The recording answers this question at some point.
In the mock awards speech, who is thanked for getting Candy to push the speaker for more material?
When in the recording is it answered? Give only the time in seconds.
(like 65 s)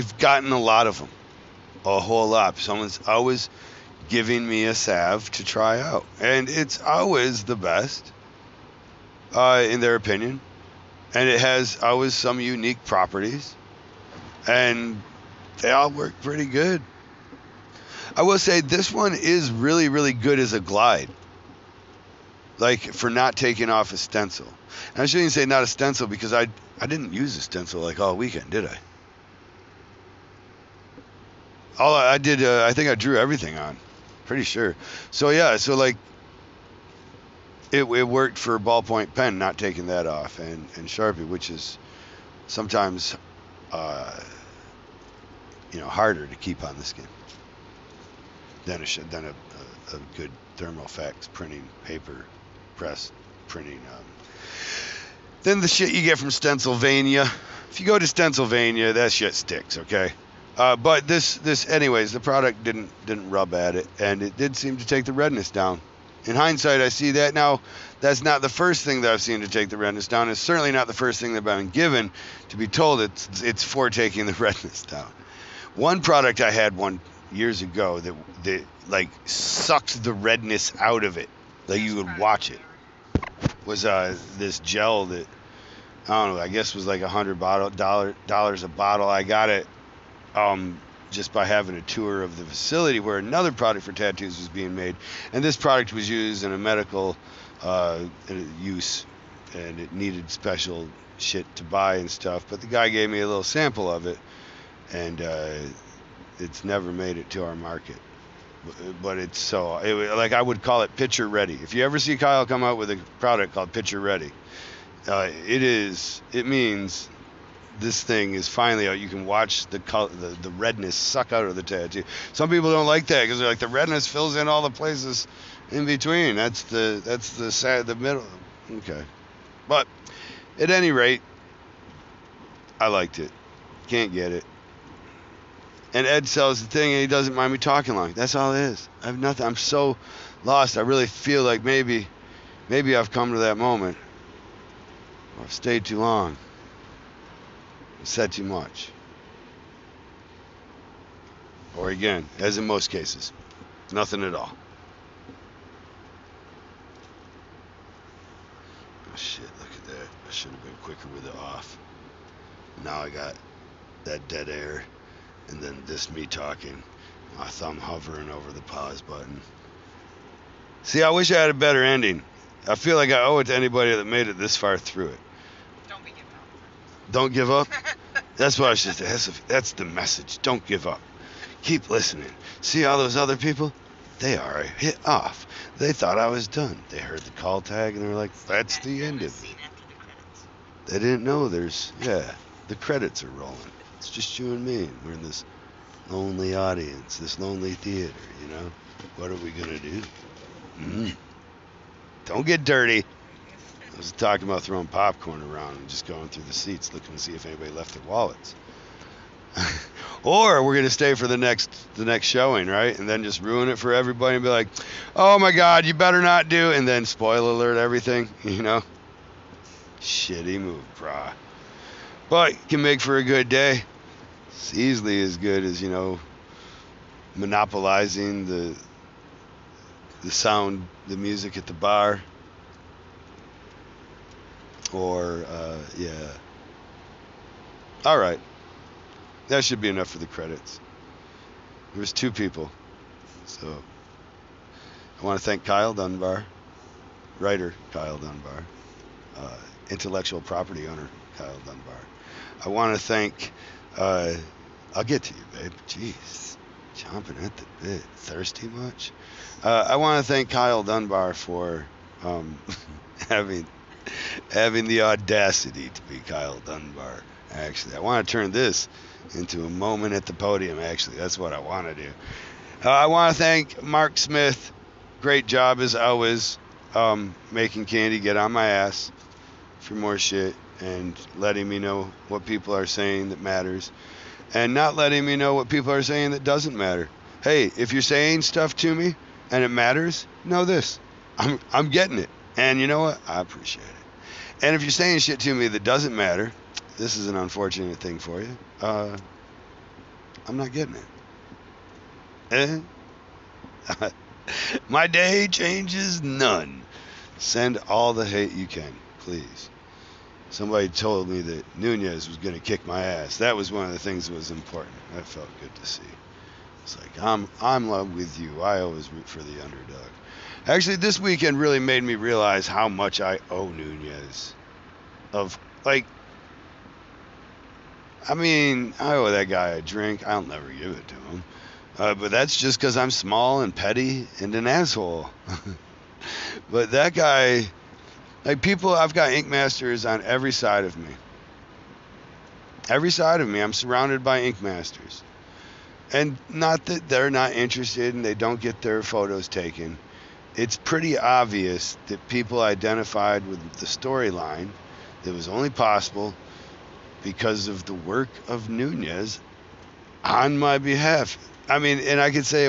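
273 s.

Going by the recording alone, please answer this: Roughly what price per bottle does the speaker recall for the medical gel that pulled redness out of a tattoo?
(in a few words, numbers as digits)
$100.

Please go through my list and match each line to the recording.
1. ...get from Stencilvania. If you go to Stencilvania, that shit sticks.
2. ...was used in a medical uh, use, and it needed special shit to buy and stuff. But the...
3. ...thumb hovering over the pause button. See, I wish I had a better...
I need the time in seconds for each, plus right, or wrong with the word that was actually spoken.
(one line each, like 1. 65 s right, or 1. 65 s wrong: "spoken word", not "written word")
1. 56 s right
2. 95 s right
3. 167 s right.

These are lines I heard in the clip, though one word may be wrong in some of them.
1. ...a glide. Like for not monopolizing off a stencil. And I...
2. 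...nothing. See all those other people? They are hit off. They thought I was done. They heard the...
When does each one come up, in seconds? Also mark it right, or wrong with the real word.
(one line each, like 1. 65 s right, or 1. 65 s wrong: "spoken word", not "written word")
1. 20 s wrong: "taking", not "monopolizing"
2. 181 s wrong: "listening", not "nothing".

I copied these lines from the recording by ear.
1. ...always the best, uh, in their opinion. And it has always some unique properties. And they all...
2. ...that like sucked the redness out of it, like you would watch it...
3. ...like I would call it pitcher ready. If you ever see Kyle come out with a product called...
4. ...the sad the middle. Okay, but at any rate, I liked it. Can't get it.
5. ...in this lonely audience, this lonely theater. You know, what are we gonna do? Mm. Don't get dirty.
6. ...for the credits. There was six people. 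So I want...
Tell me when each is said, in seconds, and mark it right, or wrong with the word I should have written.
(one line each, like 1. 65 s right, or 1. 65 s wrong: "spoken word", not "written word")
1. 6 s right
2. 78 s right
3. 110 s right
4. 127 s right
5. 195 s right
6. 240 s wrong: "two", not "six".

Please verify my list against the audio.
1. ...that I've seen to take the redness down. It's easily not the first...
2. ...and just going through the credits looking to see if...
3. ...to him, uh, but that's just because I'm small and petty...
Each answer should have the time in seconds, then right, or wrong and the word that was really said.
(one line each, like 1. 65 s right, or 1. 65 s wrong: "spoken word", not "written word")
1. 69 s wrong: "certainly", not "easily"
2. 205 s wrong: "seats", not "credits"
3. 331 s right.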